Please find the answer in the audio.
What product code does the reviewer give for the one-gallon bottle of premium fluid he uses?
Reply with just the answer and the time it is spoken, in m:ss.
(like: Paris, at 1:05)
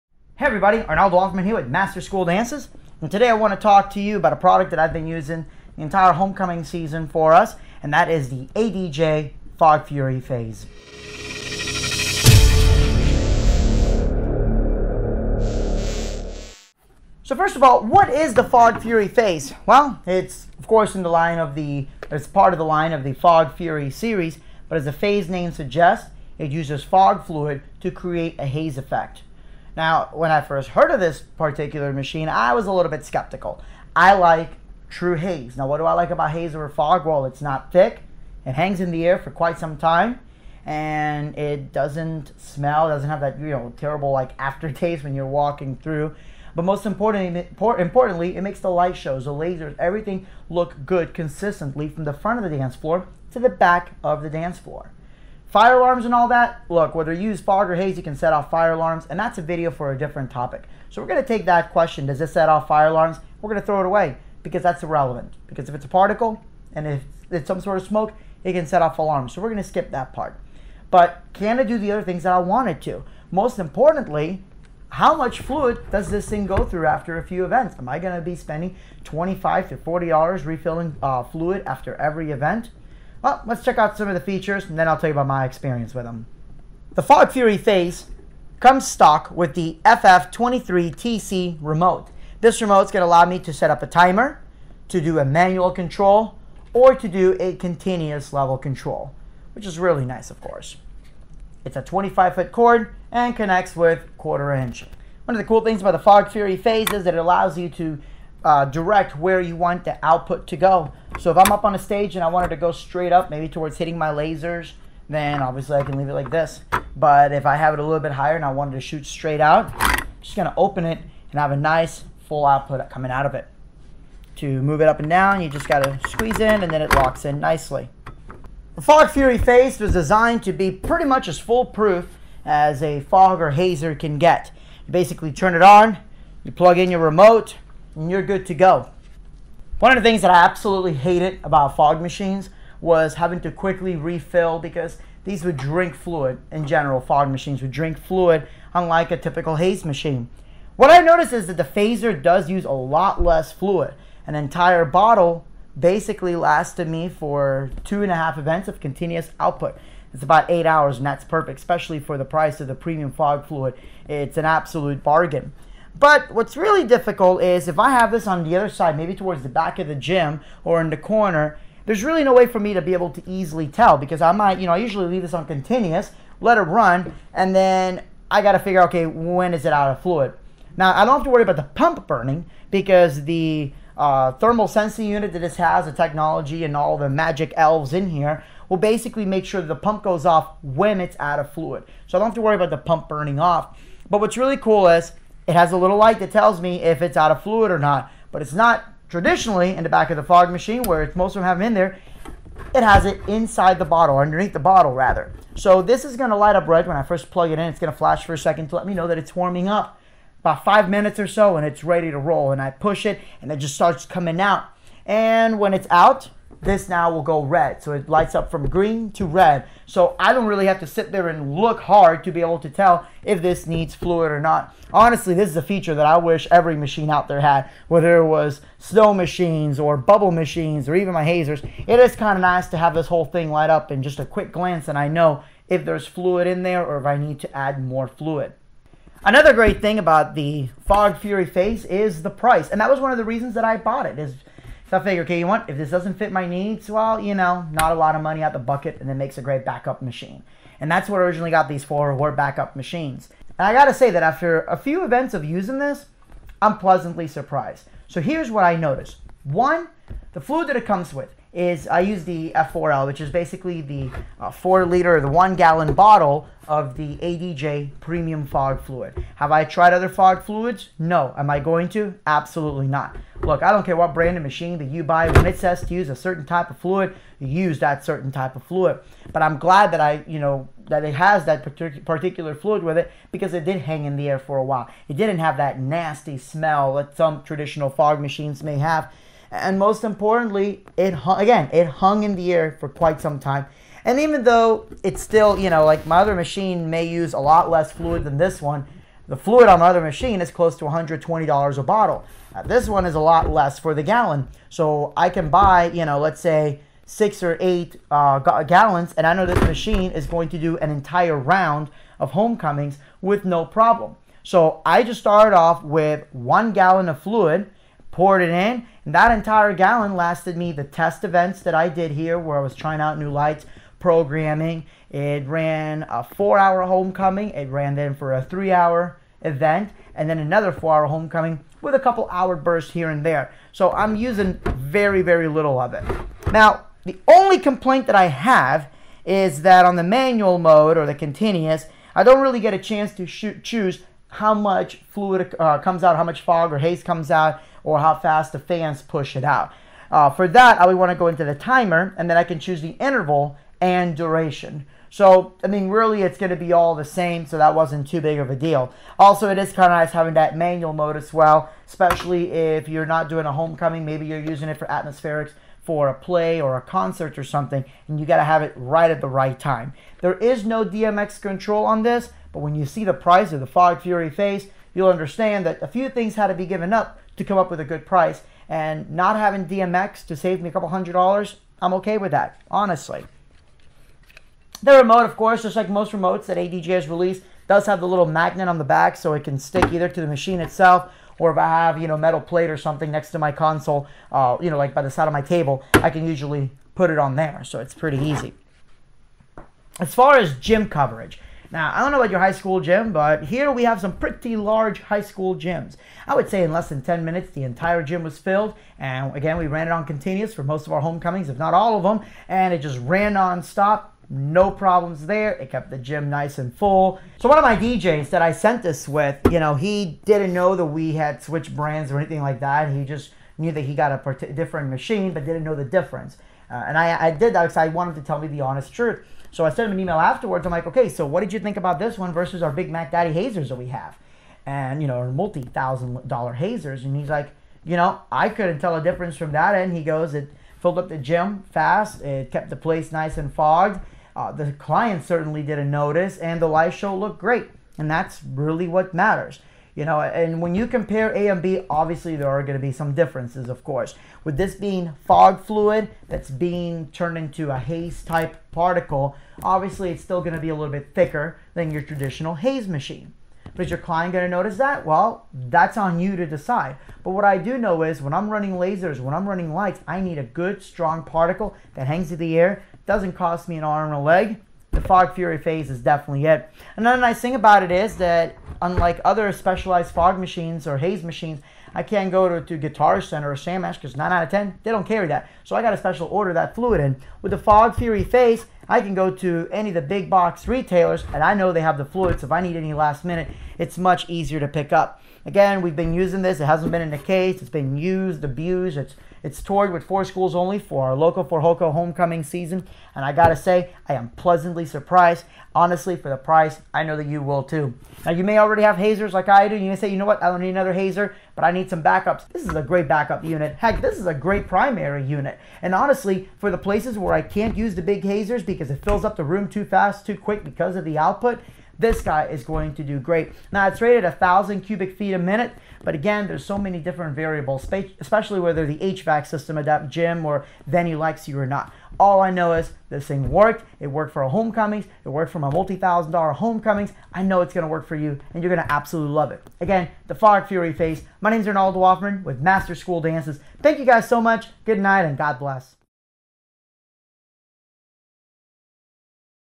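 F4L, at 4:22.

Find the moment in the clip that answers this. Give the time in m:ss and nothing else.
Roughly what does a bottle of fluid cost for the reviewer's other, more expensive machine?
5:00.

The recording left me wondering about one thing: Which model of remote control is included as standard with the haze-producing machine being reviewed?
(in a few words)
FF23TC.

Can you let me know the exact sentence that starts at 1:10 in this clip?
But can it do the other things that I wanted to?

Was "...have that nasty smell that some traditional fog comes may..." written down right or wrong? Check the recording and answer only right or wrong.
wrong.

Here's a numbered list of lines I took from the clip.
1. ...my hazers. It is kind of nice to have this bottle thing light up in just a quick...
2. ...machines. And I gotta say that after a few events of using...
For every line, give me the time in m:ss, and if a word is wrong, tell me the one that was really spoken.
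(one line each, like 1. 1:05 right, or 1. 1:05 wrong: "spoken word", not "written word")
1. 3:51 wrong: "whole", not "bottle"
2. 4:12 right.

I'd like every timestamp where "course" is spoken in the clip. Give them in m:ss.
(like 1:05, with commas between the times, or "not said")
0:20, 1:40, 6:25, 7:33.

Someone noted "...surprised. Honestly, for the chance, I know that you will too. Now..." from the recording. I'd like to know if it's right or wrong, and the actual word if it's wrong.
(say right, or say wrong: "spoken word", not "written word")
wrong: "price", not "chance".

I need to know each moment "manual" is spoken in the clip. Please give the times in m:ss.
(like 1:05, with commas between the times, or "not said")
1:35, 5:40, 6:00.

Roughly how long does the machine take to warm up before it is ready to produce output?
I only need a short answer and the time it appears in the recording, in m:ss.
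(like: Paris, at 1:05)
About five minutes, at 3:30.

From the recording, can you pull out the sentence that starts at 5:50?
Uh, for that, I would want to go into the timer, and then I can choose the interval and duration.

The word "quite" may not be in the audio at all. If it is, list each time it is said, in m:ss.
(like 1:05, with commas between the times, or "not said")
0:39, 4:52.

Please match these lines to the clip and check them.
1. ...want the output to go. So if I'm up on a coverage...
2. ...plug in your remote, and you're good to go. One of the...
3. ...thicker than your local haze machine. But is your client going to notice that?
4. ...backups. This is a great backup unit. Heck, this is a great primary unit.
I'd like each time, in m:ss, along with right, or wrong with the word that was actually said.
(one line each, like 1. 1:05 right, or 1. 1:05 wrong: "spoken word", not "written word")
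1. 1:49 wrong: "stage", not "coverage"
2. 2:16 right
3. 7:41 wrong: "traditional", not "local"
4. 8:32 right.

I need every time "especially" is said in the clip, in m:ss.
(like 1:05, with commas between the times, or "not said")
2:41, 6:01, 8:48.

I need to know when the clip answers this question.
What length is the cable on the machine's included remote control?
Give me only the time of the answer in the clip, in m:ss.
1:41.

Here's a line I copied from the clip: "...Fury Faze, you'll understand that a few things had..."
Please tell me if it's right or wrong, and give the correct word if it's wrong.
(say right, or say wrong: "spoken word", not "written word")
right.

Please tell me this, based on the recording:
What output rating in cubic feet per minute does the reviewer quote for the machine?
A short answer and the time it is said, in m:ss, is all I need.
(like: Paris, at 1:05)
1000, at 8:44.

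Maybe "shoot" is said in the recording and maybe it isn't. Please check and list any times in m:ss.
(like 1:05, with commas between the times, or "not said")
1:58, 5:43.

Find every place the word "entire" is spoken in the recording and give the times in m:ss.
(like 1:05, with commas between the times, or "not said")
0:05, 2:34, 5:10, 5:19, 6:47.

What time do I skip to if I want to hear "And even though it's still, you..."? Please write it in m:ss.
4:54.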